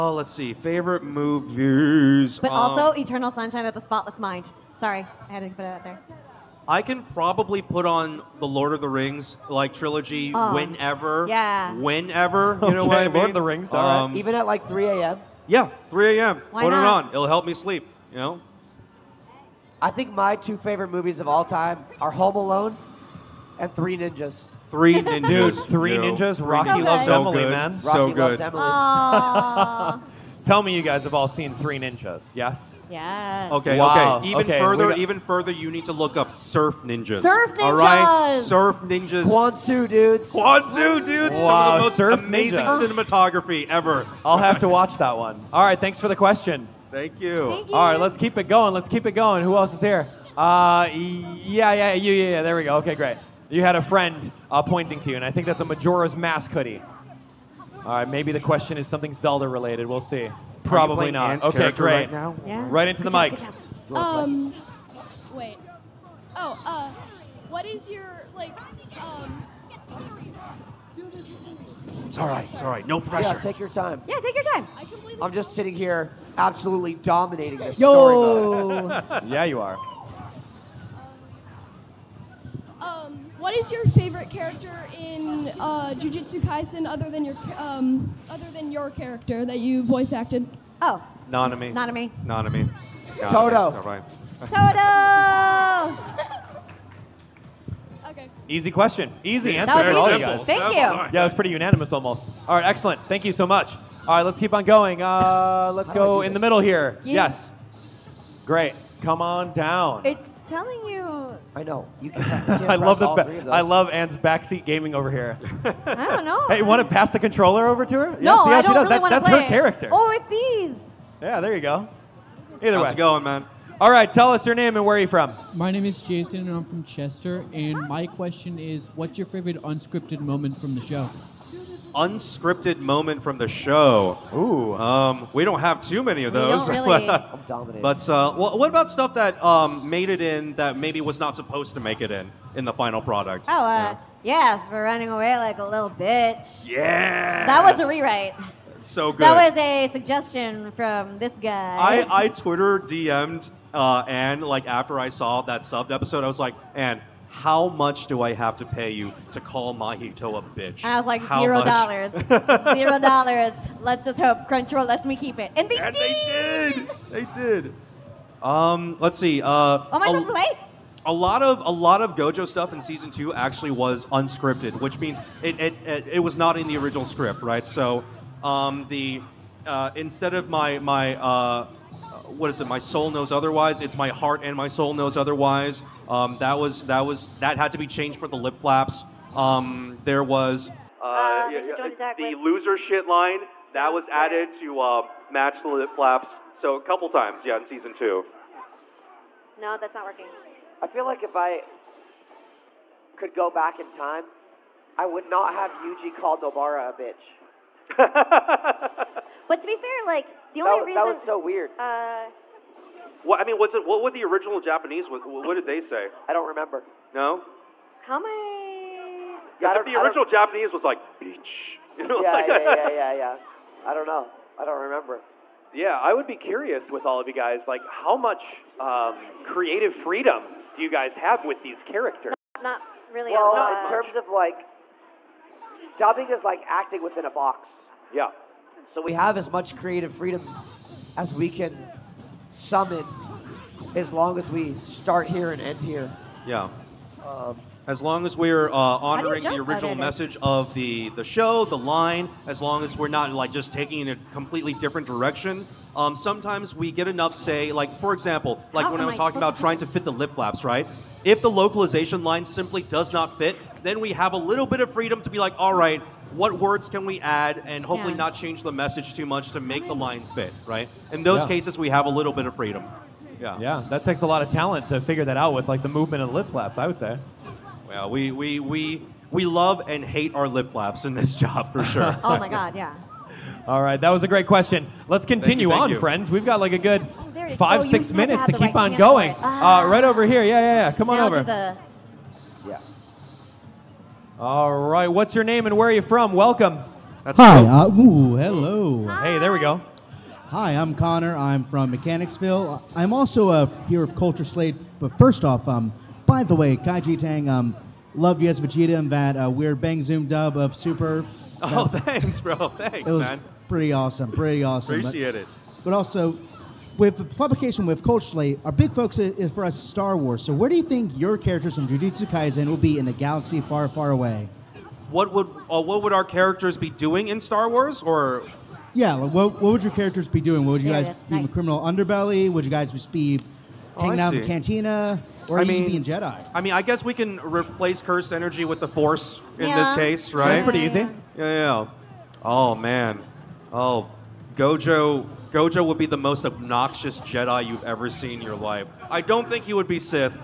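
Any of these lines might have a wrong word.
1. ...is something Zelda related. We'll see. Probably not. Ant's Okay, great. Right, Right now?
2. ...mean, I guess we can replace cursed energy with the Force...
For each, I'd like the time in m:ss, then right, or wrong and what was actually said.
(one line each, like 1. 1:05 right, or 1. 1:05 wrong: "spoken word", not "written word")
1. 0:58 right
2. 5:36 right.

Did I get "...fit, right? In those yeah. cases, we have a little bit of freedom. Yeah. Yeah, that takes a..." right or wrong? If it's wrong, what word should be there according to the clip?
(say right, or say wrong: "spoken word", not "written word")
right.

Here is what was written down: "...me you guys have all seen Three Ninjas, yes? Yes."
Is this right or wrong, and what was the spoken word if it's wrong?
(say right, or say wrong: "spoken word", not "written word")
right.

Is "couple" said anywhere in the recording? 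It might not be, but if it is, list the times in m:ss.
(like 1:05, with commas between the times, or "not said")
3:16.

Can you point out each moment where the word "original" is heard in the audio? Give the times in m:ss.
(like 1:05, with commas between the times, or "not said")
2:56, 3:34, 3:39, 4:09.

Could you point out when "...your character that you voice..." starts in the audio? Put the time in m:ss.
1:28.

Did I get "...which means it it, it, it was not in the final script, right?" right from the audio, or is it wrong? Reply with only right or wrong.
wrong.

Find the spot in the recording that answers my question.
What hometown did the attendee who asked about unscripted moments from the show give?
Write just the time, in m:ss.
2:06.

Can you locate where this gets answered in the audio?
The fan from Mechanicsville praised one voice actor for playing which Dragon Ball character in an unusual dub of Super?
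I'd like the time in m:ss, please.
5:08.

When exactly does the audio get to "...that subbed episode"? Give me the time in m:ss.
2:35.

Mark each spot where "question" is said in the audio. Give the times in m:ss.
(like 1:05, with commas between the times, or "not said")
0:46, 0:58, 1:38, 2:08, 4:44.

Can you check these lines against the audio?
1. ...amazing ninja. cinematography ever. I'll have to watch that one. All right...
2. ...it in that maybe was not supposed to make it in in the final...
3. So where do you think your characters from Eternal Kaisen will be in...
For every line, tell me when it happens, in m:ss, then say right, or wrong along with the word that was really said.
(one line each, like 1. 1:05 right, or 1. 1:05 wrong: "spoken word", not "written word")
1. 0:42 right
2. 2:20 right
3. 5:20 wrong: "Jujutsu", not "Eternal".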